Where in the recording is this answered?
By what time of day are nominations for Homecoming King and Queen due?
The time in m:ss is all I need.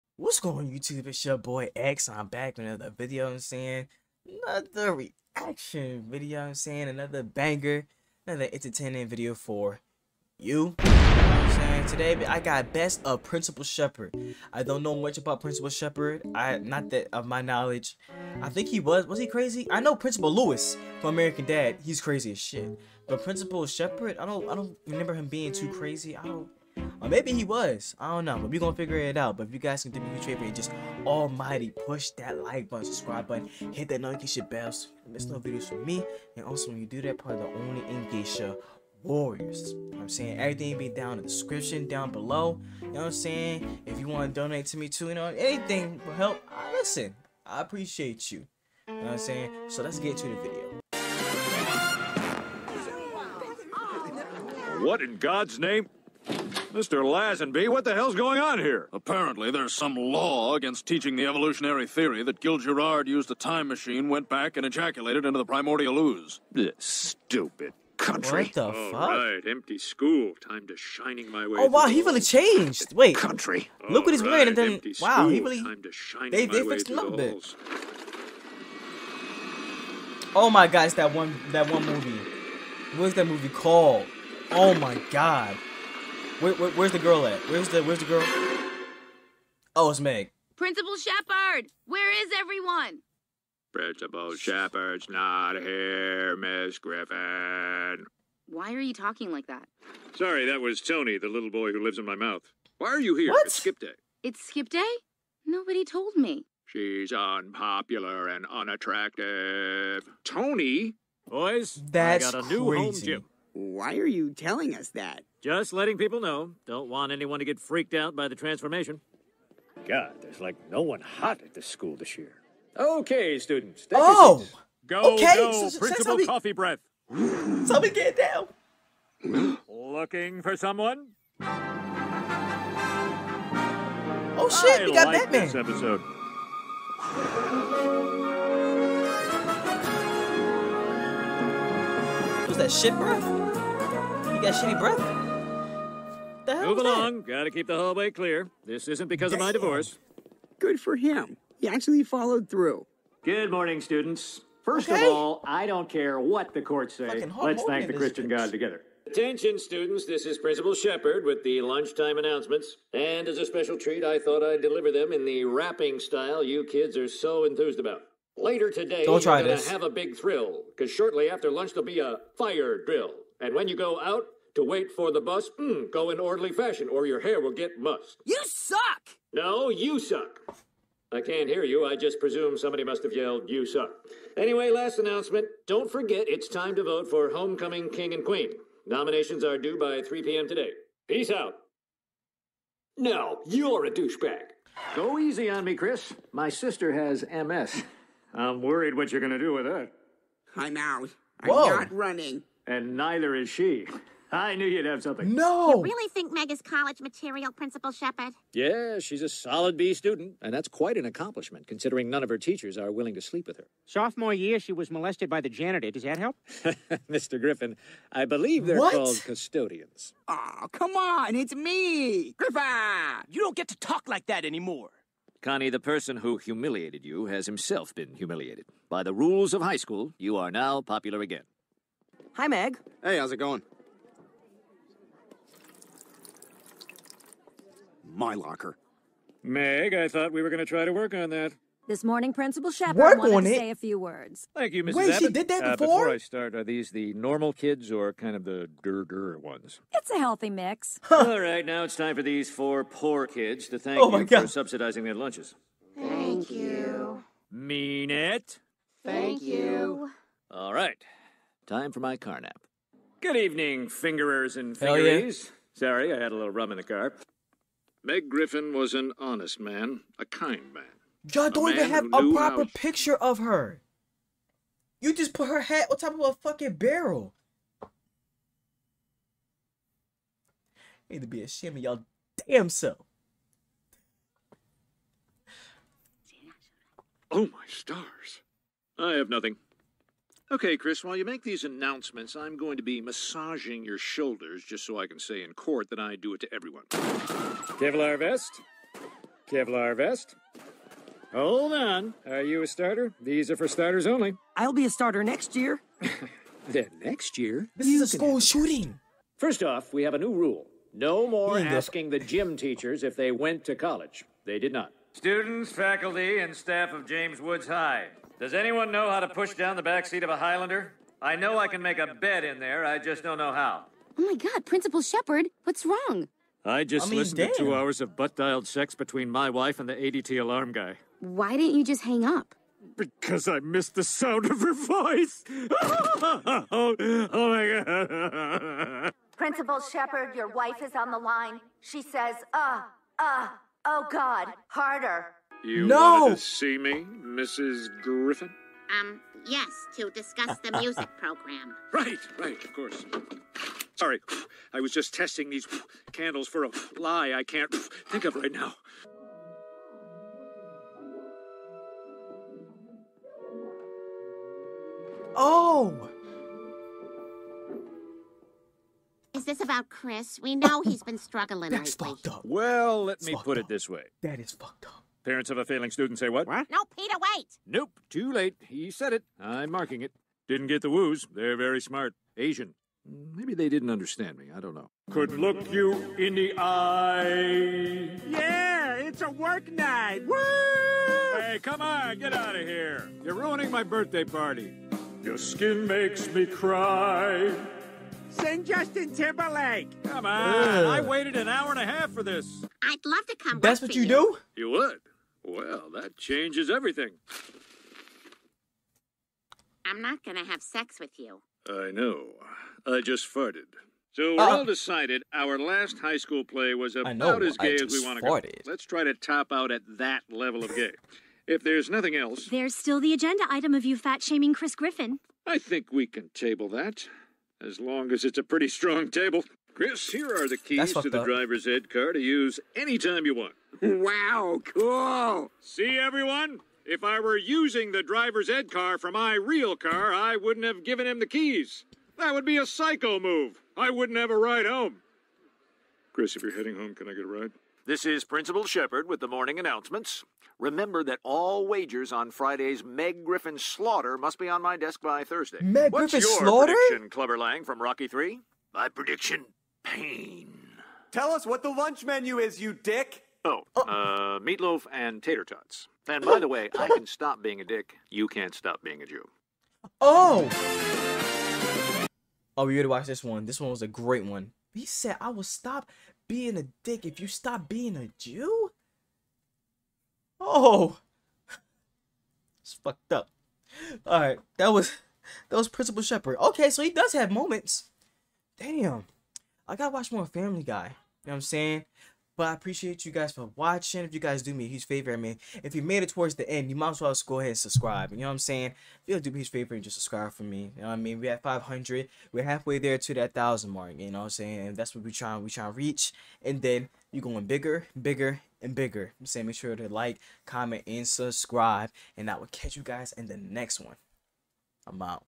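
3:10.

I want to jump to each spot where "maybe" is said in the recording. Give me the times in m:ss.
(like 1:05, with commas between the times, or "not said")
0:27, 6:23.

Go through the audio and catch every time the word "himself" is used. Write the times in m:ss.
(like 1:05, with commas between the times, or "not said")
3:47.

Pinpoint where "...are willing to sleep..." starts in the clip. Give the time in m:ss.
3:32.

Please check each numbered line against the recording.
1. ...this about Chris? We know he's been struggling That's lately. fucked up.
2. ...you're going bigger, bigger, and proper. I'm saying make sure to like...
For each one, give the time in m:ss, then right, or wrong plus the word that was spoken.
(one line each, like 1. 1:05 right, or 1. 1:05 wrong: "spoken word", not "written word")
1. 6:09 right
2. 8:27 wrong: "bigger", not "proper".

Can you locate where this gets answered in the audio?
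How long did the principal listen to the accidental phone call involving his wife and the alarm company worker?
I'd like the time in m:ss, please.
5:27.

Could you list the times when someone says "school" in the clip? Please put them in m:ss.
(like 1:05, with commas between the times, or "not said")
1:09, 2:01, 3:49, 5:08, 6:56.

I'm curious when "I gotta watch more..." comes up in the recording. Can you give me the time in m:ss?
8:09.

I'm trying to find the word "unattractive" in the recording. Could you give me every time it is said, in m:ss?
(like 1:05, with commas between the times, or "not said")
1:48.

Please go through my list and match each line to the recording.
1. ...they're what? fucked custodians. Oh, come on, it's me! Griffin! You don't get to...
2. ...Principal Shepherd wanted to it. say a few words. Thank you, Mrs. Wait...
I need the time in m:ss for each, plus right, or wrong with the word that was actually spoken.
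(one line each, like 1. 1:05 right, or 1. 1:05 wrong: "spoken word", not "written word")
1. 3:38 wrong: "called", not "fucked"
2. 4:02 right.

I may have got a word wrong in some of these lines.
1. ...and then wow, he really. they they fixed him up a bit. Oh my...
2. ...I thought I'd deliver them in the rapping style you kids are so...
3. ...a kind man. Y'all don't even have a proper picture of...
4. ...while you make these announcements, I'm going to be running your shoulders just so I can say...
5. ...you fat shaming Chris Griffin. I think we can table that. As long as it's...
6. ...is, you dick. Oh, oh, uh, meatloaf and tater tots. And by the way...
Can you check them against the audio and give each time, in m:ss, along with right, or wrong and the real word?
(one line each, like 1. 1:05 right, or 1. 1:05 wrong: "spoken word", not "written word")
1. 1:14 right
2. 2:44 right
3. 4:30 right
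4. 4:51 wrong: "massaging", not "running"
5. 7:03 right
6. 7:42 right.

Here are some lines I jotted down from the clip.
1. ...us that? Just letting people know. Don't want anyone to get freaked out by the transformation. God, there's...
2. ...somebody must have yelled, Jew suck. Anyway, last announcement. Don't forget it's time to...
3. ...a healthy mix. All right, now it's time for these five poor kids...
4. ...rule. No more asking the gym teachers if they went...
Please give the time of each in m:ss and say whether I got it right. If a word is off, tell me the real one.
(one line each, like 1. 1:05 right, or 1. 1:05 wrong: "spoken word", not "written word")
1. 1:54 right
2. 3:02 wrong: "You", not "Jew"
3. 4:10 wrong: "four", not "five"
4. 5:10 right.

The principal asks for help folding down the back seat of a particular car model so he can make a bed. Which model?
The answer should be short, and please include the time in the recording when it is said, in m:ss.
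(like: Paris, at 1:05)
Highlander, at 5:20.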